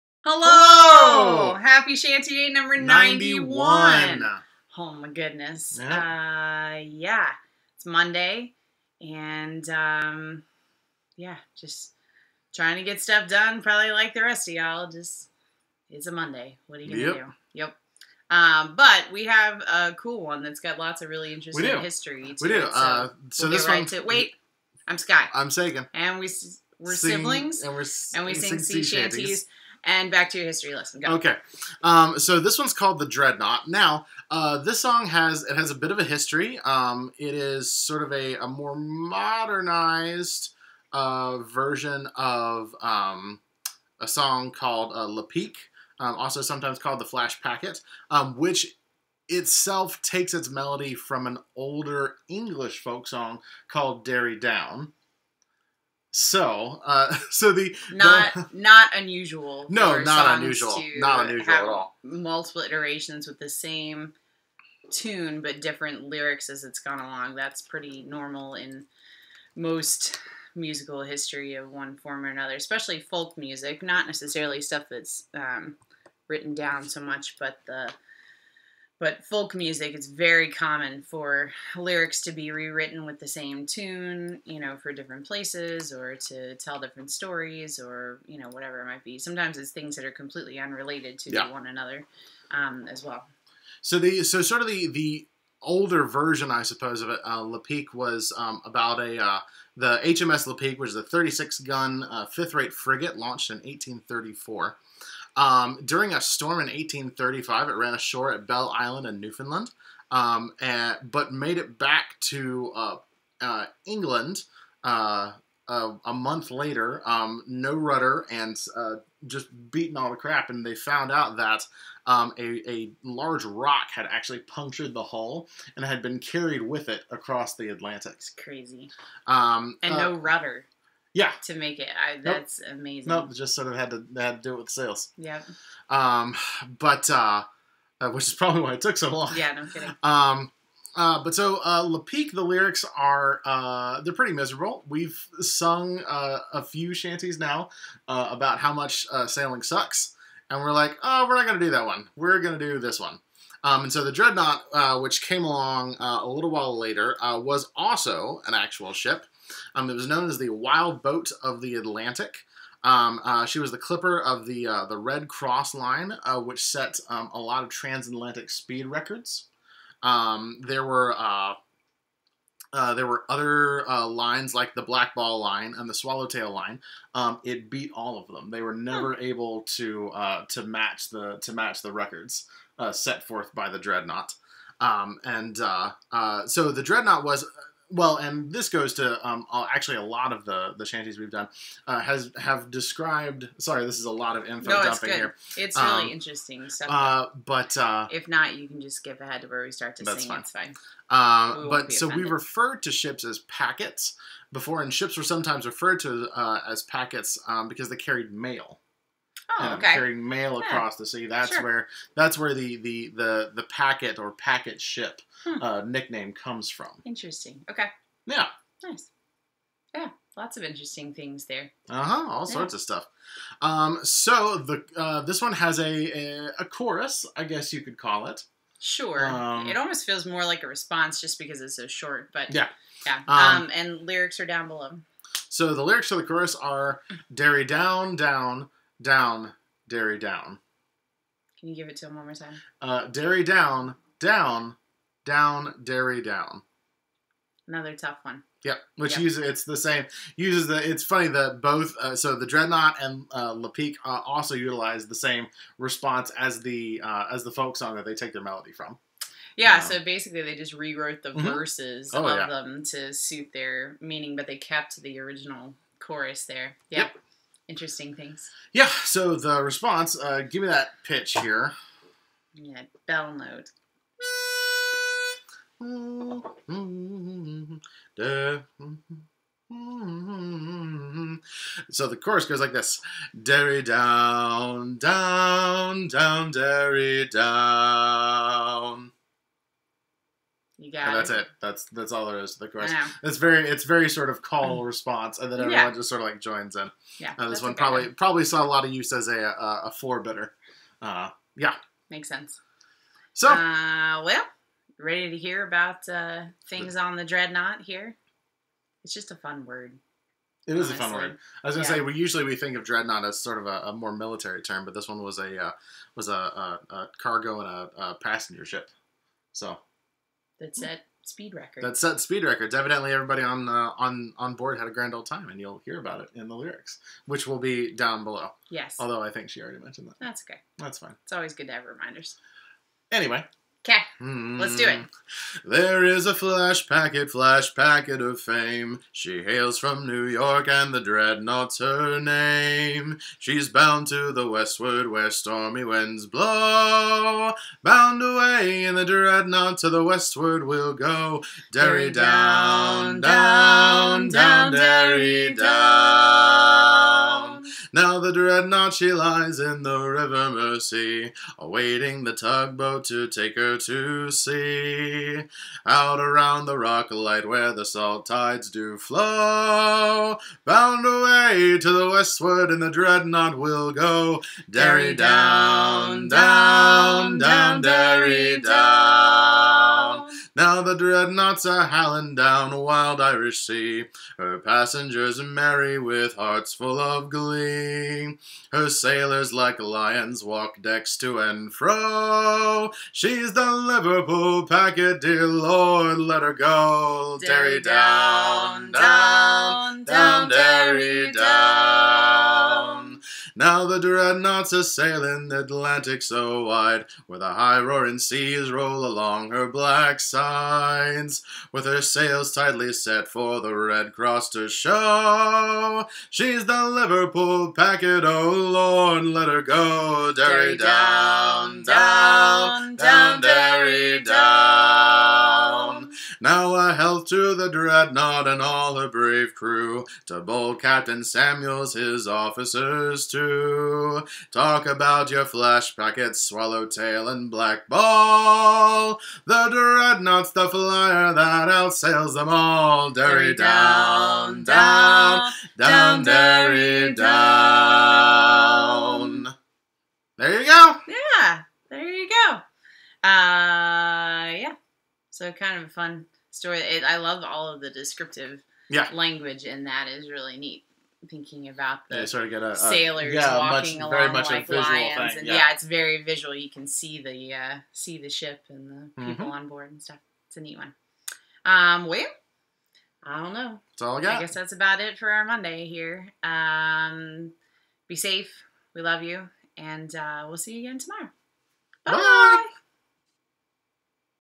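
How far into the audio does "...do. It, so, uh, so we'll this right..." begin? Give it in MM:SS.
00:22.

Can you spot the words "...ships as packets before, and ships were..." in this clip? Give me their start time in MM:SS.
03:22.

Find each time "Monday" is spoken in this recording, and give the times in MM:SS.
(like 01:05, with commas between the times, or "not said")
00:07, 00:16, 07:55.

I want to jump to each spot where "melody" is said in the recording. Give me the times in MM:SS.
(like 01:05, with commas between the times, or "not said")
00:50, 04:18.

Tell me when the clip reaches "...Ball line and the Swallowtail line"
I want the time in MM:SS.
02:55.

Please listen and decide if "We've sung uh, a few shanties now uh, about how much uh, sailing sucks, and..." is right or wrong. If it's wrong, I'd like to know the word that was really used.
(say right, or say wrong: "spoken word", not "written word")
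right.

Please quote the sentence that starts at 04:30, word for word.
Uh, give me that pitch here.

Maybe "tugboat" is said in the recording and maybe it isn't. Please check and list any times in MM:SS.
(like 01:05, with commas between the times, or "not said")
06:02.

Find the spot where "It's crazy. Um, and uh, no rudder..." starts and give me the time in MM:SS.
02:08.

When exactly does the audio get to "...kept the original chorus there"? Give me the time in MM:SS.
04:24.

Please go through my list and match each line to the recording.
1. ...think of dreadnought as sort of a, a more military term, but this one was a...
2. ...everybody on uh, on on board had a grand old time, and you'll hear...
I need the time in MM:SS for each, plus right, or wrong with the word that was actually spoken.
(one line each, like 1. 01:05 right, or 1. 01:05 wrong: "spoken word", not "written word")
1. 05:12 right
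2. 05:23 right.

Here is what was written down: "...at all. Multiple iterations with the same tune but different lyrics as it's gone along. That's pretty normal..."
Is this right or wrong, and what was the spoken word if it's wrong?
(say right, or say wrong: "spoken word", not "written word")
right.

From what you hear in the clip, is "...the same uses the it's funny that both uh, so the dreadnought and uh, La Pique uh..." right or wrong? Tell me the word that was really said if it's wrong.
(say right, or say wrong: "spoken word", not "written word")
right.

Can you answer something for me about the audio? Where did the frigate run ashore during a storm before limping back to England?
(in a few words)
Belle Island.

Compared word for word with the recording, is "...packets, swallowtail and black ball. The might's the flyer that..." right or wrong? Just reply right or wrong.
wrong.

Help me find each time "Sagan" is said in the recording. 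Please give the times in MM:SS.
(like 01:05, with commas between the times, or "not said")
00:25.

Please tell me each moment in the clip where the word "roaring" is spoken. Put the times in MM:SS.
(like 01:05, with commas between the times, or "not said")
06:47.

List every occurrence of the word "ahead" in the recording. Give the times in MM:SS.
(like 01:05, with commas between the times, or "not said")
03:19.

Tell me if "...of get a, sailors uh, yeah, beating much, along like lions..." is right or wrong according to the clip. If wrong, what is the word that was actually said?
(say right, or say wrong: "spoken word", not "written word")
wrong: "walking", not "beating".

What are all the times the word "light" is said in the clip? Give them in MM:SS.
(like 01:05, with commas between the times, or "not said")
06:07.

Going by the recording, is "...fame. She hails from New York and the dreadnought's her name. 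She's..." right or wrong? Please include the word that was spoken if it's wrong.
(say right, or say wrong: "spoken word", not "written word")
right.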